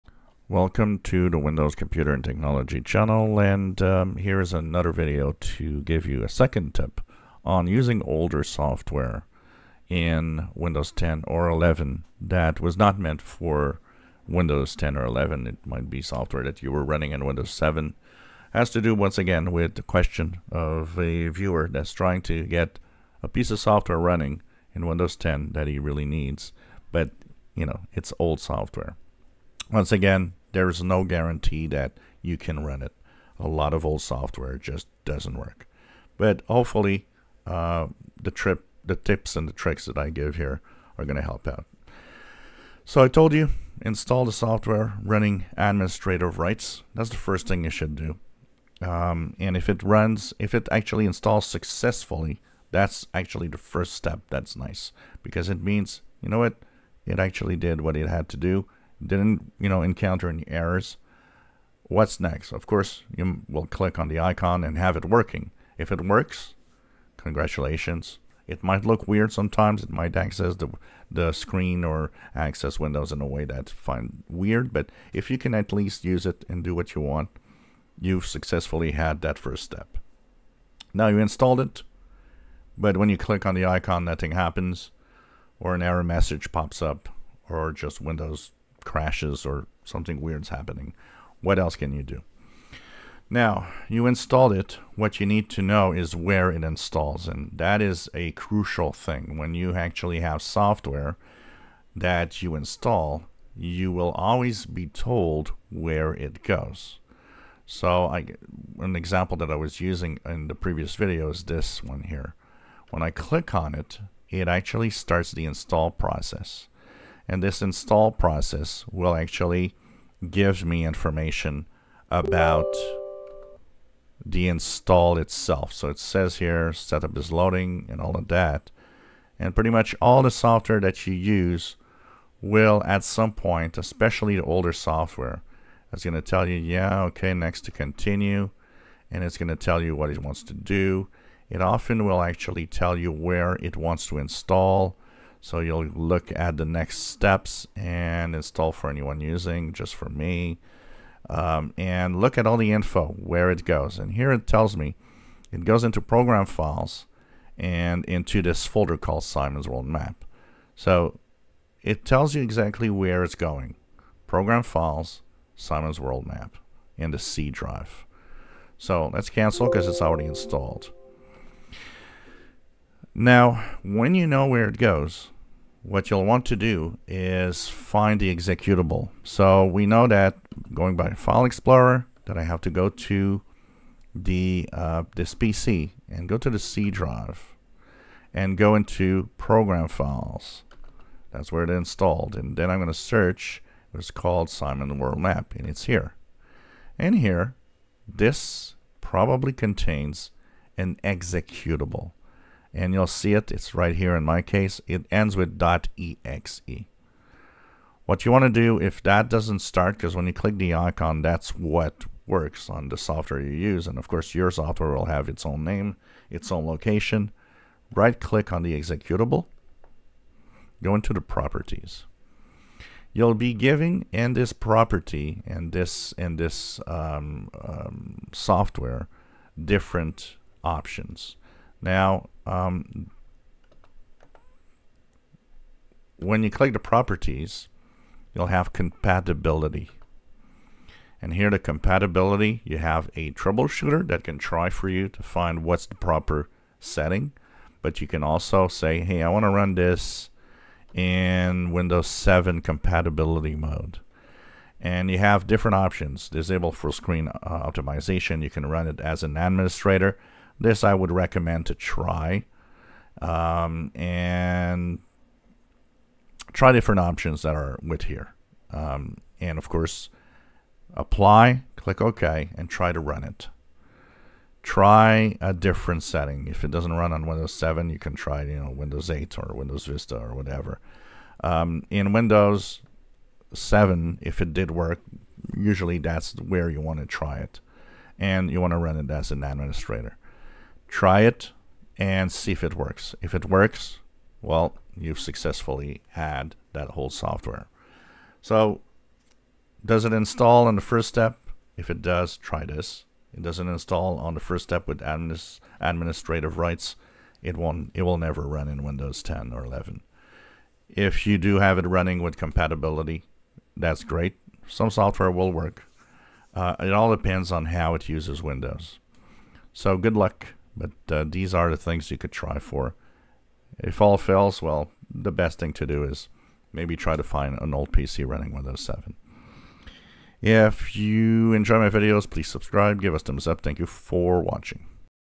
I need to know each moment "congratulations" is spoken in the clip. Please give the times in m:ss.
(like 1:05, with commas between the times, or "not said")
1:07.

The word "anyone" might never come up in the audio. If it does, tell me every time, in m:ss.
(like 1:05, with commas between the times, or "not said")
2:28.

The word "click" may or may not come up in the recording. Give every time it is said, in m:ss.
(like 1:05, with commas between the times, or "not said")
1:03, 1:23, 1:53, 3:30, 3:38, 3:56, 4:31.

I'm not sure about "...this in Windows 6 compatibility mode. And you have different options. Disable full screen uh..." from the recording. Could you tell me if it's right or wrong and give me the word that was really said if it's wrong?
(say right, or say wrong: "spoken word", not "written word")
wrong: "7", not "6".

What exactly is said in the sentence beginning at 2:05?
So it says here setup is loading and all of that.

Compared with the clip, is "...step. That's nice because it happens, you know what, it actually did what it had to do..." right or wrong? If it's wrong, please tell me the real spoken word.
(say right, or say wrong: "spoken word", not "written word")
wrong: "means", not "happens".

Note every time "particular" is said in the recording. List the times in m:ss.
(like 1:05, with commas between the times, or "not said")
not said.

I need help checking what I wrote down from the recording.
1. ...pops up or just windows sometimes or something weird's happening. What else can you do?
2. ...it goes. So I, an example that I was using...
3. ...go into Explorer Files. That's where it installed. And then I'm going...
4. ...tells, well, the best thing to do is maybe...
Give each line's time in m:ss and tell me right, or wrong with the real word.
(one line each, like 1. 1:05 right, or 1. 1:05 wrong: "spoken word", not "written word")
1. 1:26 wrong: "crashes", not "sometimes"
2. 1:46 right
3. 3:08 wrong: "Program", not "Explorer"
4. 5:24 wrong: "fails", not "tells".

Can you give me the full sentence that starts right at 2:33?
And here it tells me it goes into program files and into this folder called Simon's World Map.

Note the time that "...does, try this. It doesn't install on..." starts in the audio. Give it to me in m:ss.
5:02.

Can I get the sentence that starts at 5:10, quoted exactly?
If you do have it running with compatibility, that's great.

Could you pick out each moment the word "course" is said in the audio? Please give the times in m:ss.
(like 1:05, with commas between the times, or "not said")
1:02, 3:34, 4:29.